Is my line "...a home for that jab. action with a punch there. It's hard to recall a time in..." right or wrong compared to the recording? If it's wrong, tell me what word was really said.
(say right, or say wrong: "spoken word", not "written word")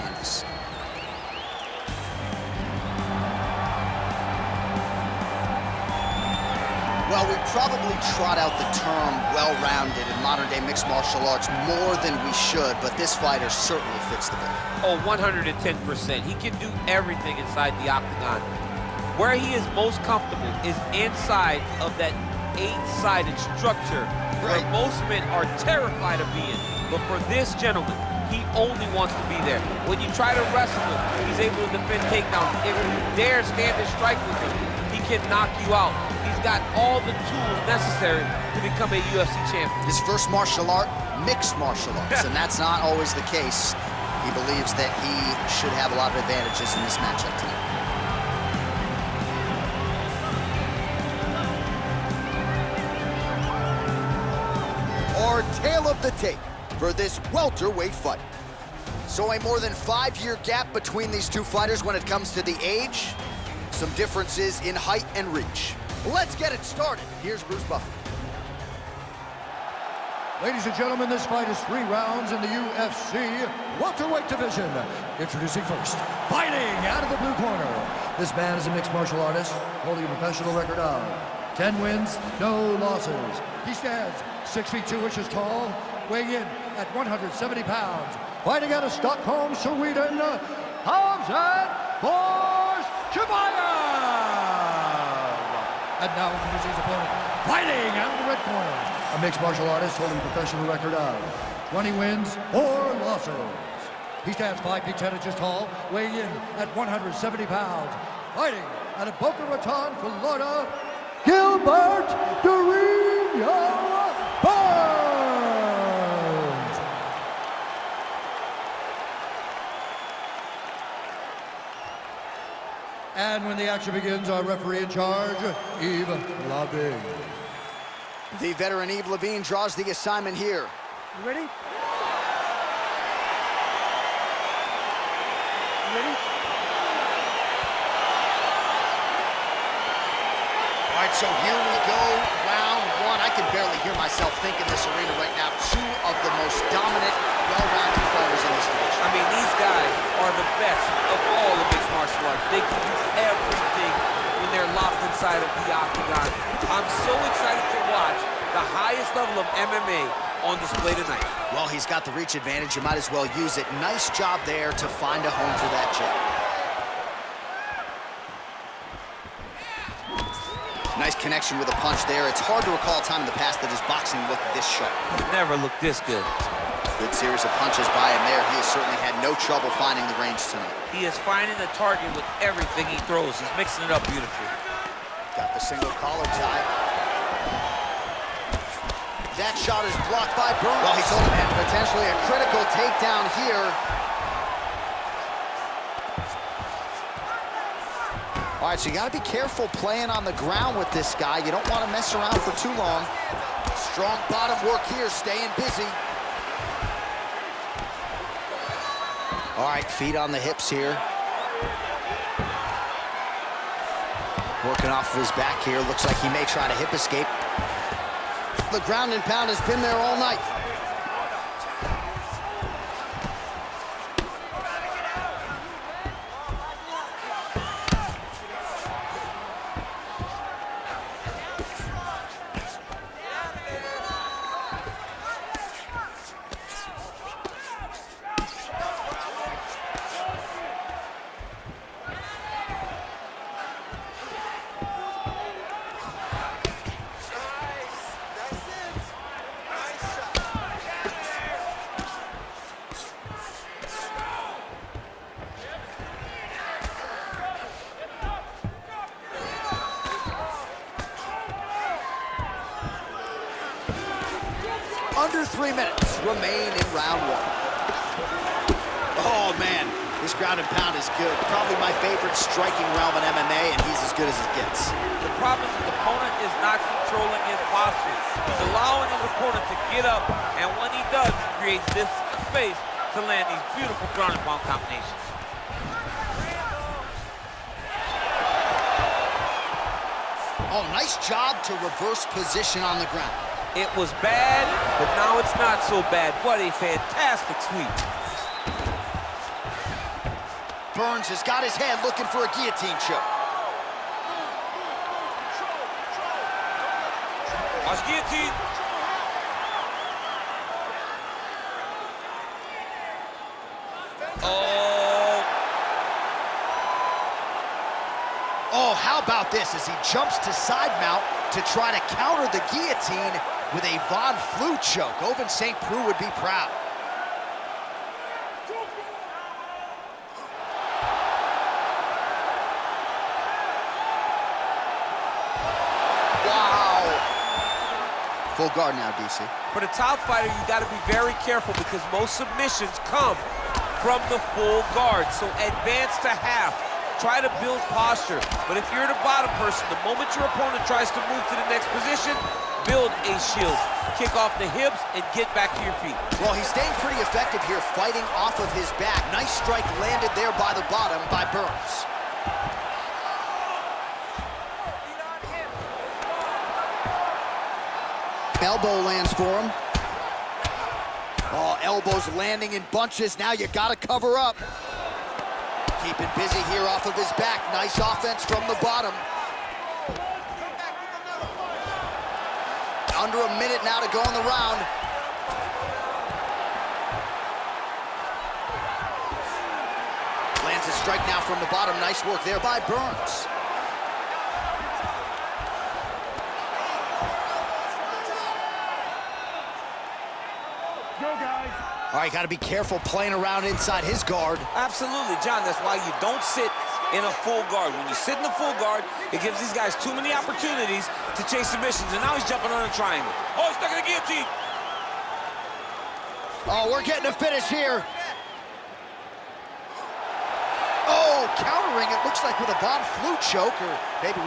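wrong: "connection", not "action".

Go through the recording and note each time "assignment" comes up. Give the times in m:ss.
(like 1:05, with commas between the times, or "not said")
2:09.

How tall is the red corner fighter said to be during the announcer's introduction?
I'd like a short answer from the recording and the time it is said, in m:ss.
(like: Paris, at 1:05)
5 feet 10 inches, at 1:44.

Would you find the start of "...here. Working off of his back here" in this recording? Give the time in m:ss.
3:30.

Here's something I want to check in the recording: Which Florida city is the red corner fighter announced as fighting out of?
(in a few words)
Boca Raton.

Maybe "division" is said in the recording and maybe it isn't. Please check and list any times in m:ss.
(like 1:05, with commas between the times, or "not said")
1:14, 2:28.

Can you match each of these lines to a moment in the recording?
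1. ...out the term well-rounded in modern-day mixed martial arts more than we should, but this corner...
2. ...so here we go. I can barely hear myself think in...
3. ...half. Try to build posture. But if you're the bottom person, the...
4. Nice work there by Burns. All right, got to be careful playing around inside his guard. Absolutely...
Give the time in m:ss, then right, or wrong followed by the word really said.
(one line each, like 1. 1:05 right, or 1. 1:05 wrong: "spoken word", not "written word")
1. 0:08 wrong: "fighter", not "corner"
2. 2:21 right
3. 5:46 right
4. 6:31 right.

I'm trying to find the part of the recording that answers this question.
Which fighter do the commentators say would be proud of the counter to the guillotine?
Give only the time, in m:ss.
5:25.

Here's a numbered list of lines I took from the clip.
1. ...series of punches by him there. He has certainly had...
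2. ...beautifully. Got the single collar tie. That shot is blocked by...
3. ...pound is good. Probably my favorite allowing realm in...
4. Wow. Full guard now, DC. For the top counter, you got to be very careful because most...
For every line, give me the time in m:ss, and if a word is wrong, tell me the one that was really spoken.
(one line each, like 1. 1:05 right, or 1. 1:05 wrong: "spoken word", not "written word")
1. 2:57 right
2. 3:04 right
3. 4:30 wrong: "striking", not "allowing"
4. 5:36 wrong: "fighter", not "counter".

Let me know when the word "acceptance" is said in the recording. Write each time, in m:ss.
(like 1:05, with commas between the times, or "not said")
not said.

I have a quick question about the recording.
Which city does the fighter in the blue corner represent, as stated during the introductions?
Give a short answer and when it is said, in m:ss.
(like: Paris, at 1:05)
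Stockholm, Sweden, at 1:28.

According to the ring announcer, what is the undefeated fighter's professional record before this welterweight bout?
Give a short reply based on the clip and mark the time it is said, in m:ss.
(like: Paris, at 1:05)
10 wins, no losses, at 1:21.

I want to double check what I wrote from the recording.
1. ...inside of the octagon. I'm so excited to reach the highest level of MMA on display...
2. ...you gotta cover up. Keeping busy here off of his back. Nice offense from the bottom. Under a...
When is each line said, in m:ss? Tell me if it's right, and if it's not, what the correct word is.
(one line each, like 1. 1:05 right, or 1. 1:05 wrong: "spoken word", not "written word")
1. 2:35 wrong: "watch", not "reach"
2. 6:13 right.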